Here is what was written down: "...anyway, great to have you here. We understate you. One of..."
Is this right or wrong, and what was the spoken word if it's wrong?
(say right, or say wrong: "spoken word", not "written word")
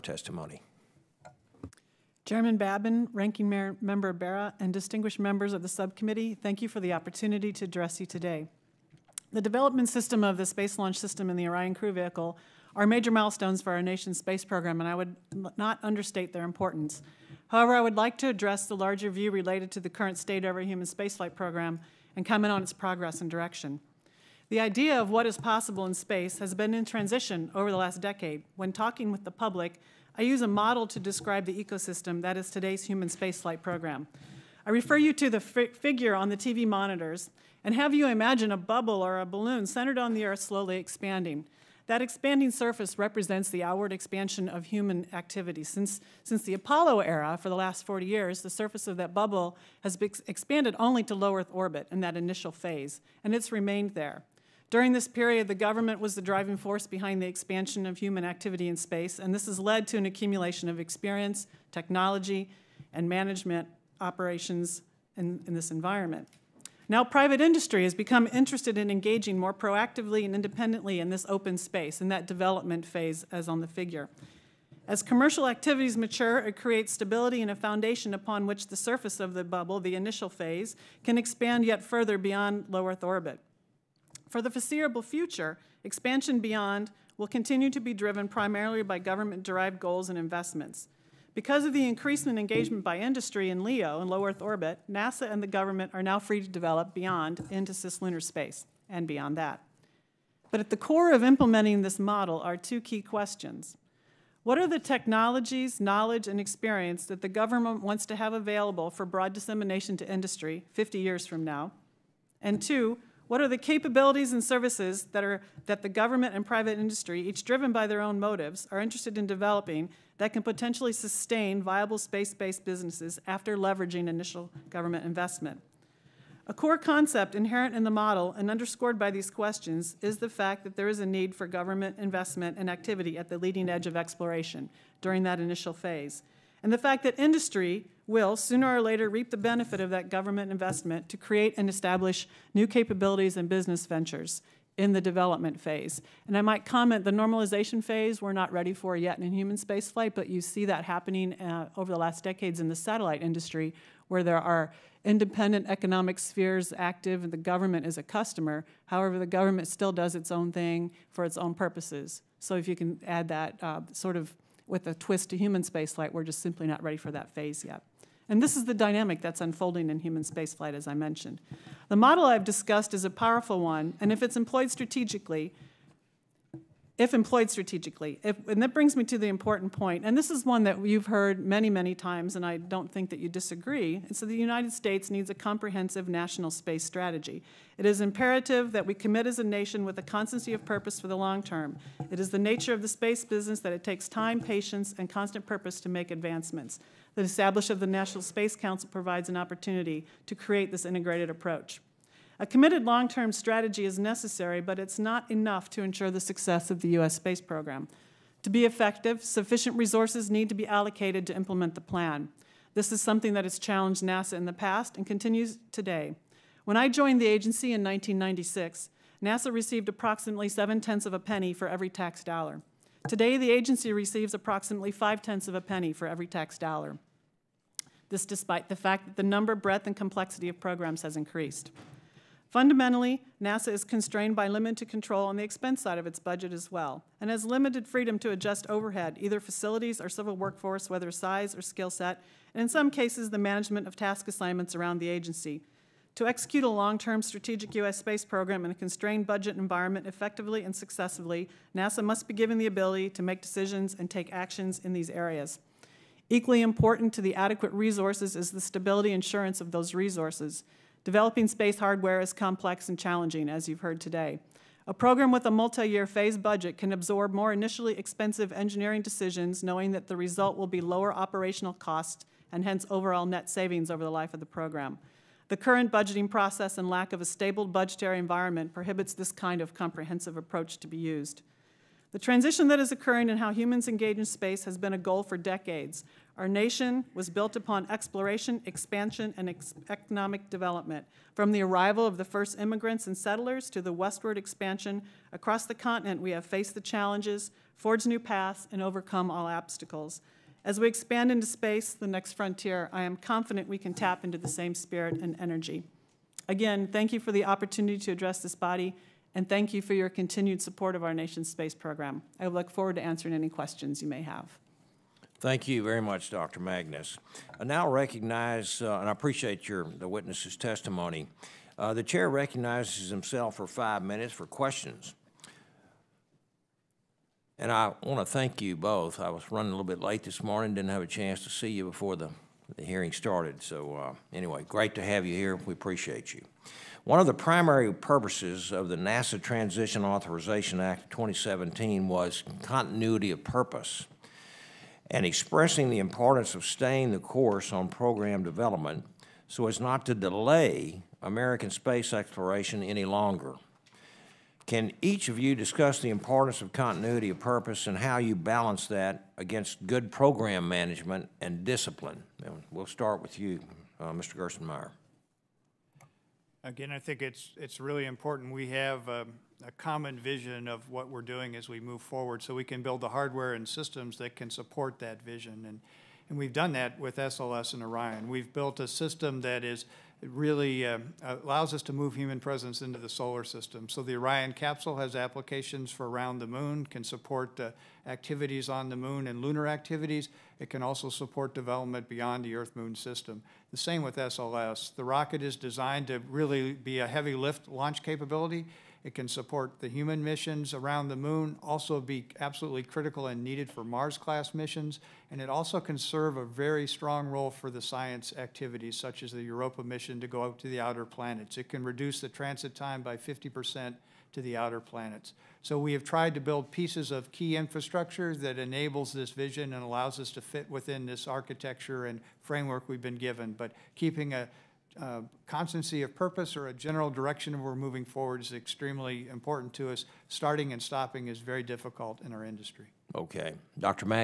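wrong: "appreciate", not "understate".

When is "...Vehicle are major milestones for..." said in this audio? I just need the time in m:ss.
0:11.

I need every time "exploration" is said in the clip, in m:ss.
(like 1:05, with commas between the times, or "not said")
2:13, 4:47, 5:52.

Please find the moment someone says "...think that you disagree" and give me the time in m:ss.
3:02.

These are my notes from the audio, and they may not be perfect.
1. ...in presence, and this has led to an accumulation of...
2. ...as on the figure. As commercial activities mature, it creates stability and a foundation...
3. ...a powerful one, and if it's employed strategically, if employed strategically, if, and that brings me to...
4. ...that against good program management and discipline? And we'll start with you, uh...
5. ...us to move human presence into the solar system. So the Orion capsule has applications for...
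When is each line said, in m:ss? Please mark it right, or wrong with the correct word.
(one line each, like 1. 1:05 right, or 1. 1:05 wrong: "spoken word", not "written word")
1. 0:58 wrong: "space", not "presence"
2. 1:13 right
3. 2:53 right
4. 5:58 right
5. 6:21 right.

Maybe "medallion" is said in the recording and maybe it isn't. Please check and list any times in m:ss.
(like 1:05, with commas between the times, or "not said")
not said.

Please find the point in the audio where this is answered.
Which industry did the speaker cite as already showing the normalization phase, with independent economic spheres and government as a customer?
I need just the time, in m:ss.
2:32.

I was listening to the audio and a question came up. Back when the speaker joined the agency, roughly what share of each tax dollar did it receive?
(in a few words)
seven tenths of a penny.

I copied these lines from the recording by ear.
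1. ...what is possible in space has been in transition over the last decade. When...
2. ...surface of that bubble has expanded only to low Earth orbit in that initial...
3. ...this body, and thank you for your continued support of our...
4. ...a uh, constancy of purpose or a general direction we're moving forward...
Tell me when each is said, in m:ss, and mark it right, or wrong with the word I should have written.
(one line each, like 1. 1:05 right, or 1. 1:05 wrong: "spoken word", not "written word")
1. 0:25 right
2. 0:48 right
3. 5:08 right
4. 7:04 right.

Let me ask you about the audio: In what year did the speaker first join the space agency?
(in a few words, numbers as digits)
1996.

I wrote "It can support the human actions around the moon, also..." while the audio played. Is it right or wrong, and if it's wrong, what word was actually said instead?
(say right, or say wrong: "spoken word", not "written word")
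wrong: "missions", not "actions".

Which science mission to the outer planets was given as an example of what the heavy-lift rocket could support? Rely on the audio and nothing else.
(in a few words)
Europa mission.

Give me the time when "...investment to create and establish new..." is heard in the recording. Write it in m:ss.
2:20.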